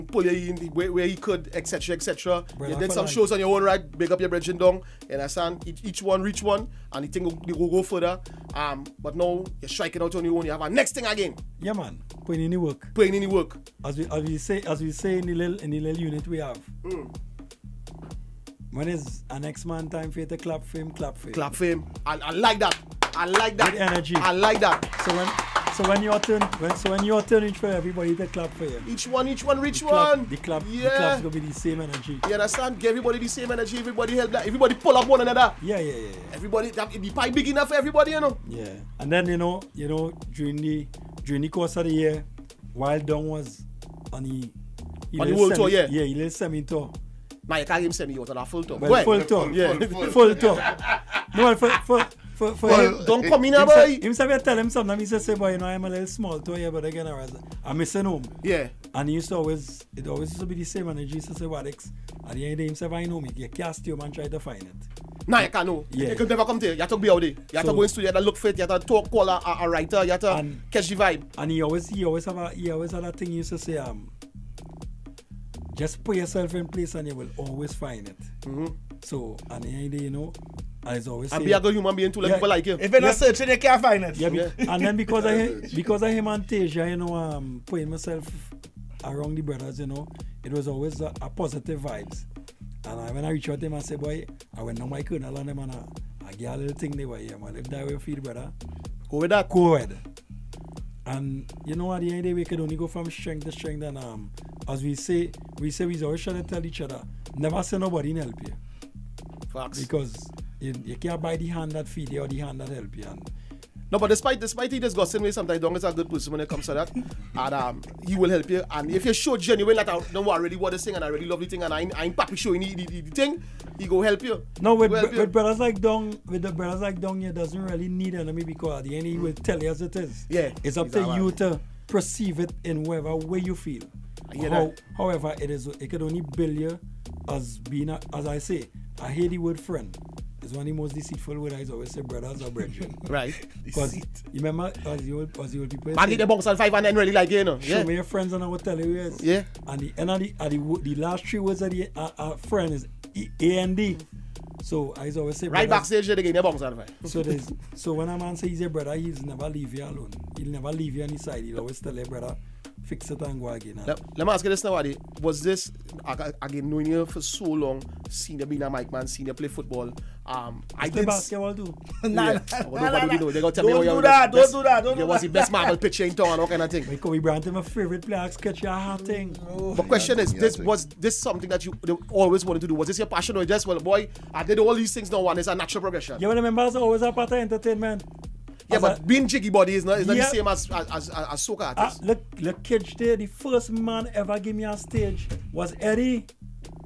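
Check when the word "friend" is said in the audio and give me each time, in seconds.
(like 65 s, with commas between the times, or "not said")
139 s, 148 s, 152 s.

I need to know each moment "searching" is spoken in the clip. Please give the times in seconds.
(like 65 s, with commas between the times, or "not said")
83 s.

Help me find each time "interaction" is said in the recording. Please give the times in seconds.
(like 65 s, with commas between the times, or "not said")
not said.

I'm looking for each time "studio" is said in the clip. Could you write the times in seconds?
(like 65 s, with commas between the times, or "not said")
67 s.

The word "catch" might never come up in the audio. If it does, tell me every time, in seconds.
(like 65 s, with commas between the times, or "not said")
70 s.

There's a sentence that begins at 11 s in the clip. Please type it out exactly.
Yeah man, putting in the work.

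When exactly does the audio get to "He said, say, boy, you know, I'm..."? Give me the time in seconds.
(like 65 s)
54 s.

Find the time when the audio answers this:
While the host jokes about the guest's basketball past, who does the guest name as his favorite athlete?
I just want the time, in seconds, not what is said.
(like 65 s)
177 s.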